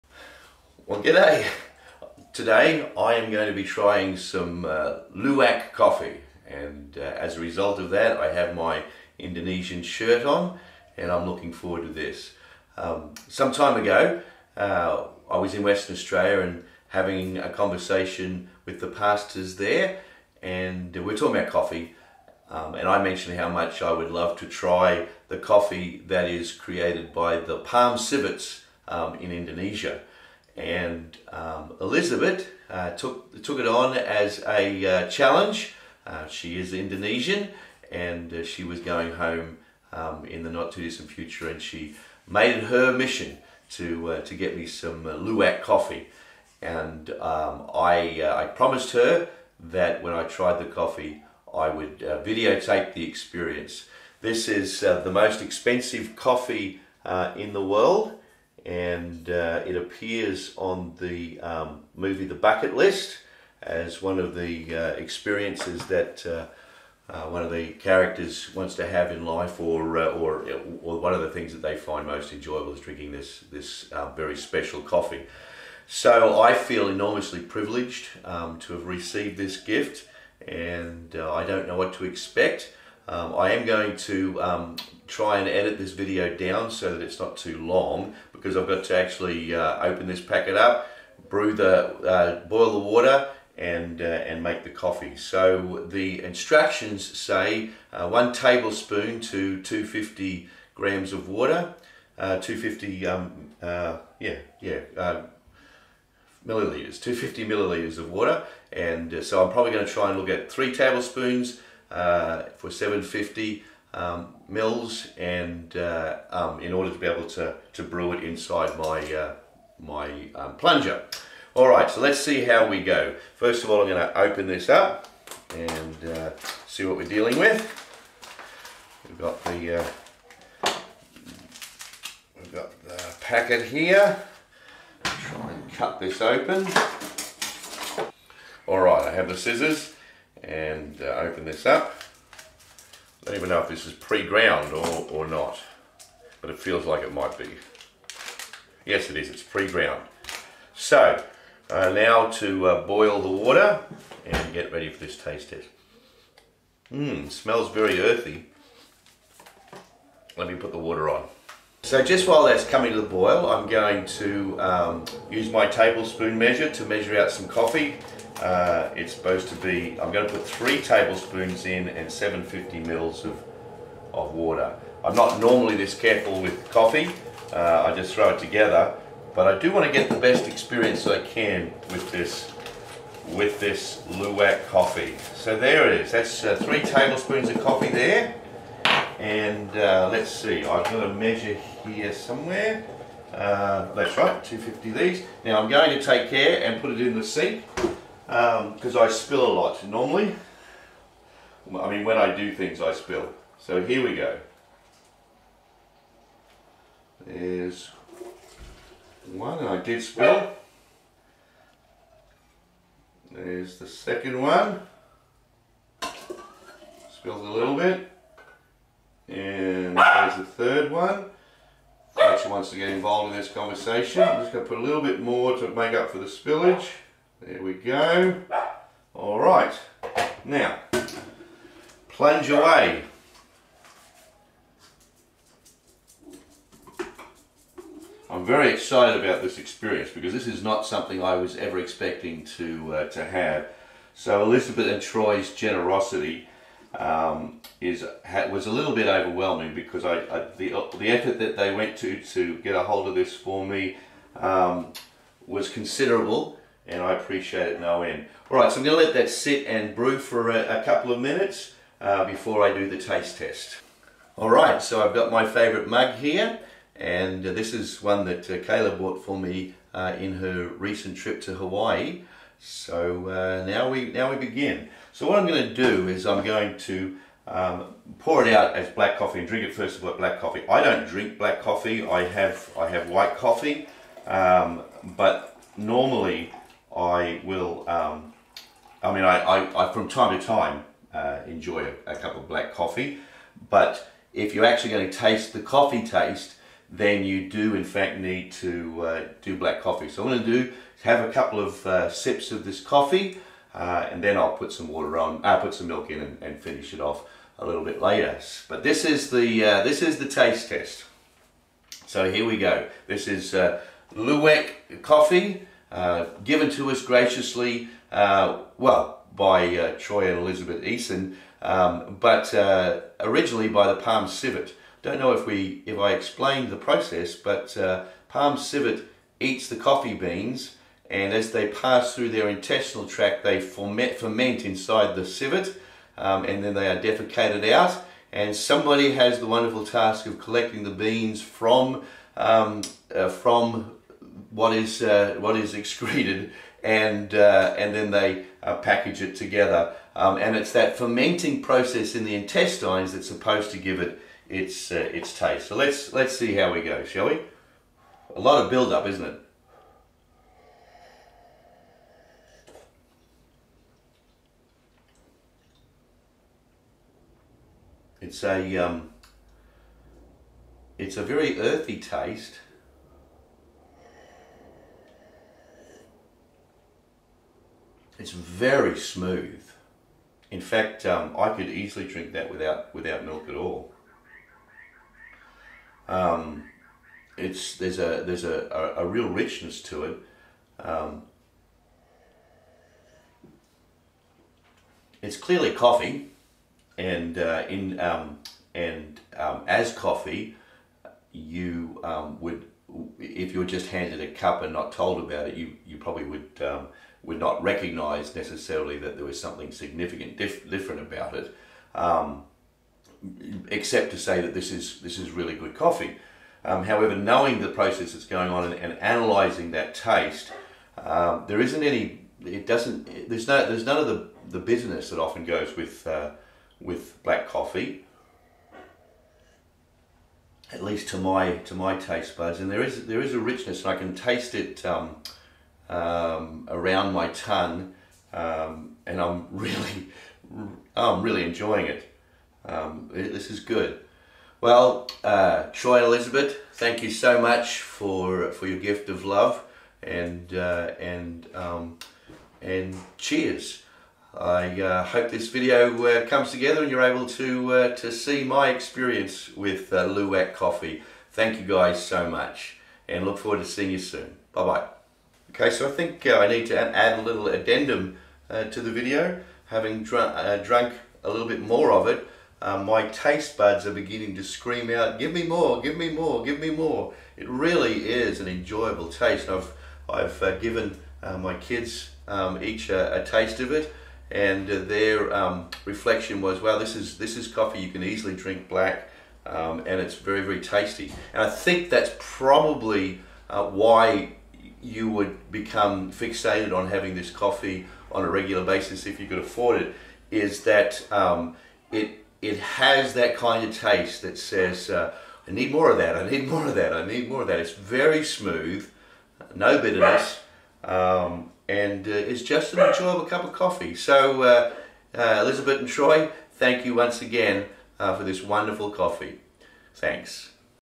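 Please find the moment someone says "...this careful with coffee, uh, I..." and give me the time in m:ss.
2:55.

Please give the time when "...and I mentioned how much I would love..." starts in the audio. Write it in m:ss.
0:22.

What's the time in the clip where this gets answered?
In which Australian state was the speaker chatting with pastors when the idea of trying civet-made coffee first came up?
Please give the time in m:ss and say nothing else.
0:15.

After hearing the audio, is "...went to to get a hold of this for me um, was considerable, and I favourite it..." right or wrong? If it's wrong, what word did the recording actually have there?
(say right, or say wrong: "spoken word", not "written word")
wrong: "appreciate", not "favourite".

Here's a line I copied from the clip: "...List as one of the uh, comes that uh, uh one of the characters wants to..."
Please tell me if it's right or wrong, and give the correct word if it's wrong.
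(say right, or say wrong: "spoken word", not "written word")
wrong: "experiences", not "comes".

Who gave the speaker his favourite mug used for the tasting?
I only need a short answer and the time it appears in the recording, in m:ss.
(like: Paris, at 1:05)
Kayla, at 4:28.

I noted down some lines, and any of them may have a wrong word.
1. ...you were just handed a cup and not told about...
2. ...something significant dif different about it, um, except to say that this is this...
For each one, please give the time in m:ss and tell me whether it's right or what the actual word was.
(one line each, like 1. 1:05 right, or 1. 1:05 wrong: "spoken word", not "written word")
1. 6:43 right
2. 6:49 right.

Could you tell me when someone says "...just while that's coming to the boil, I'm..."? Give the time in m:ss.
2:42.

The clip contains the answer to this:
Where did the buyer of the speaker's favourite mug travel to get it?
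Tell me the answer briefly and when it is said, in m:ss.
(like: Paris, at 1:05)
Hawaii, at 4:31.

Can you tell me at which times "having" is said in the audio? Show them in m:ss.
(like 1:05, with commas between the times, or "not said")
0:16, 7:49, 8:16.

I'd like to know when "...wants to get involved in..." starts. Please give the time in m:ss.
3:42.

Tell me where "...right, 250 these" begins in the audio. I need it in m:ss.
3:14.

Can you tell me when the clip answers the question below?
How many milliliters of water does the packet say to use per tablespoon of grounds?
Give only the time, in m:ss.
1:47.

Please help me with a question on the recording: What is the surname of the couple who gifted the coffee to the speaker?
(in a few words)
Eason.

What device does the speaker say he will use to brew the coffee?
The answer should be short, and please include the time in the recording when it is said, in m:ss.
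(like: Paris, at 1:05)
Plunger, at 2:00.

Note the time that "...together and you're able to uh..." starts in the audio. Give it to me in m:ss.
7:36.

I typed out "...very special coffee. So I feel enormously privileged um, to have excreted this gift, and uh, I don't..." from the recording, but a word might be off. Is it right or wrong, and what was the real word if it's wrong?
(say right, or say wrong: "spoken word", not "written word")
wrong: "received", not "excreted".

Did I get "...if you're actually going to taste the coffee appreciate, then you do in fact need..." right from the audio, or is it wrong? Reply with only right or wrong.
wrong.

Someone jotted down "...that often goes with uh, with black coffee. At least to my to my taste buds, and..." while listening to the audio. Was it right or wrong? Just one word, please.
right.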